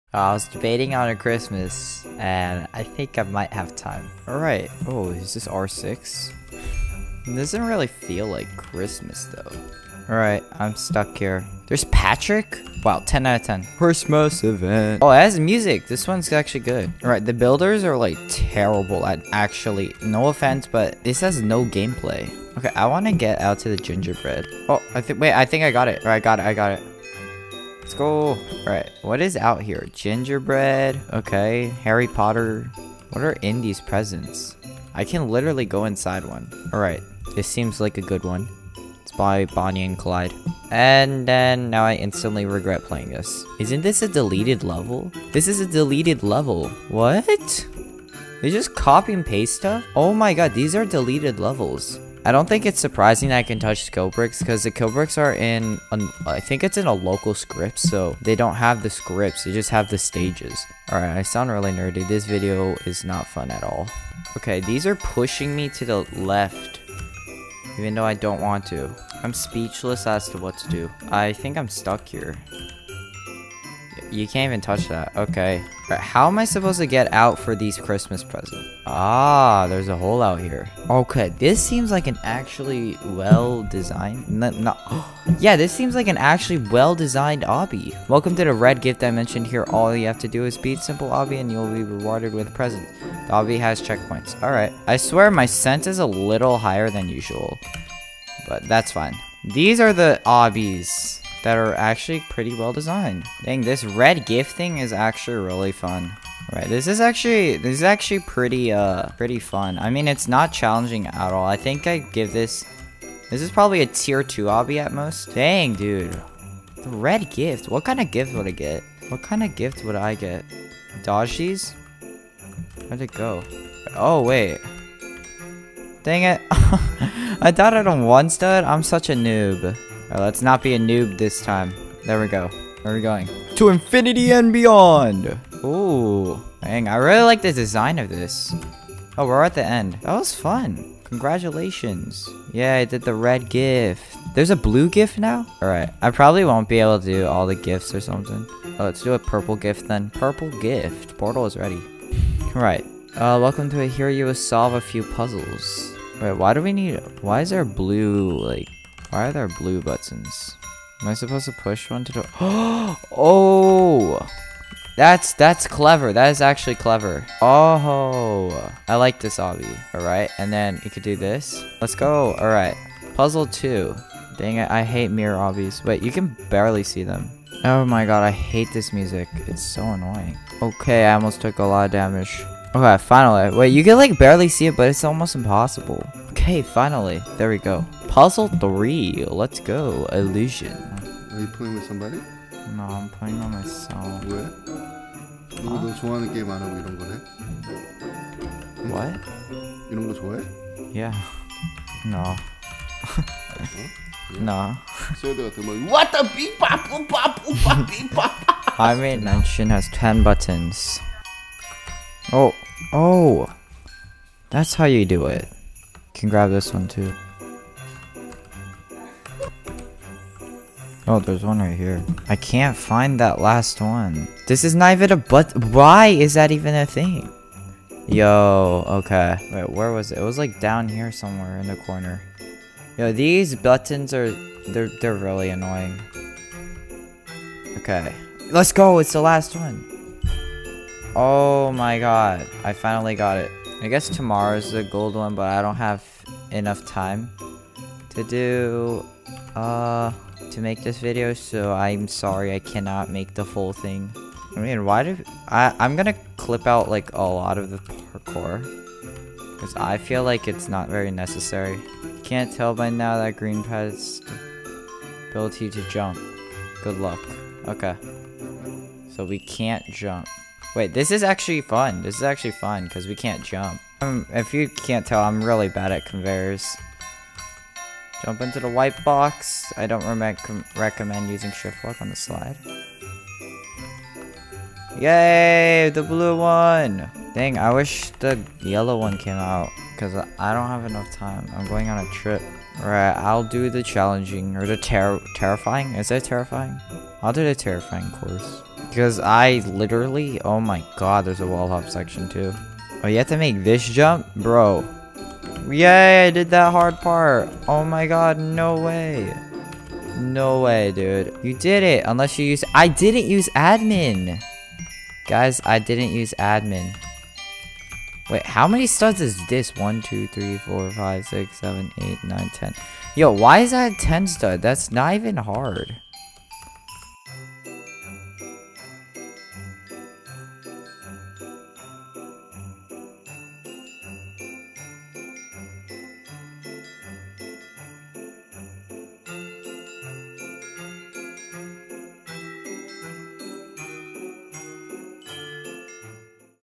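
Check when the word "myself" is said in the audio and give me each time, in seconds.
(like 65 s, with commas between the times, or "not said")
193 s.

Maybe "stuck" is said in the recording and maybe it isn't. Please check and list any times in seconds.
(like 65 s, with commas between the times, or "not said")
10 s, 71 s.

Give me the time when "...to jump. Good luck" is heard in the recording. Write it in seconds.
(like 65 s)
265 s.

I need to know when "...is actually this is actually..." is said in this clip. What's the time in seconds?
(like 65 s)
106 s.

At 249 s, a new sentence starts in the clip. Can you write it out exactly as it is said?
Uh to make this video, so I'm sorry I cannot make the full thing.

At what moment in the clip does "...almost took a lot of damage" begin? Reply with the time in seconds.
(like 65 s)
181 s.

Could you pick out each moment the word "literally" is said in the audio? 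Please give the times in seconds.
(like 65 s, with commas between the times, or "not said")
35 s, 299 s.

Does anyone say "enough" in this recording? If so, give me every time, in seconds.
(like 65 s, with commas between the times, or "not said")
246 s, 290 s.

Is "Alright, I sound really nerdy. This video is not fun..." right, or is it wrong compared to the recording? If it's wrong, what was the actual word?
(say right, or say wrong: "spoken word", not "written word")
right.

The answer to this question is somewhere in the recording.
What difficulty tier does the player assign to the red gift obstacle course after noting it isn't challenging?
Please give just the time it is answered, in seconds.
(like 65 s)
113 s.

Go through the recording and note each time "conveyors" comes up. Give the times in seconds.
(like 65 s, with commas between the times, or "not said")
276 s.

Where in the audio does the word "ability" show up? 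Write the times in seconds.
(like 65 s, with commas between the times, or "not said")
265 s.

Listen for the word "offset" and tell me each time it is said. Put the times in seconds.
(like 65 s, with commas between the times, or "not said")
not said.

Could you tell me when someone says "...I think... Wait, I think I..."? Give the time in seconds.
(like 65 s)
24 s.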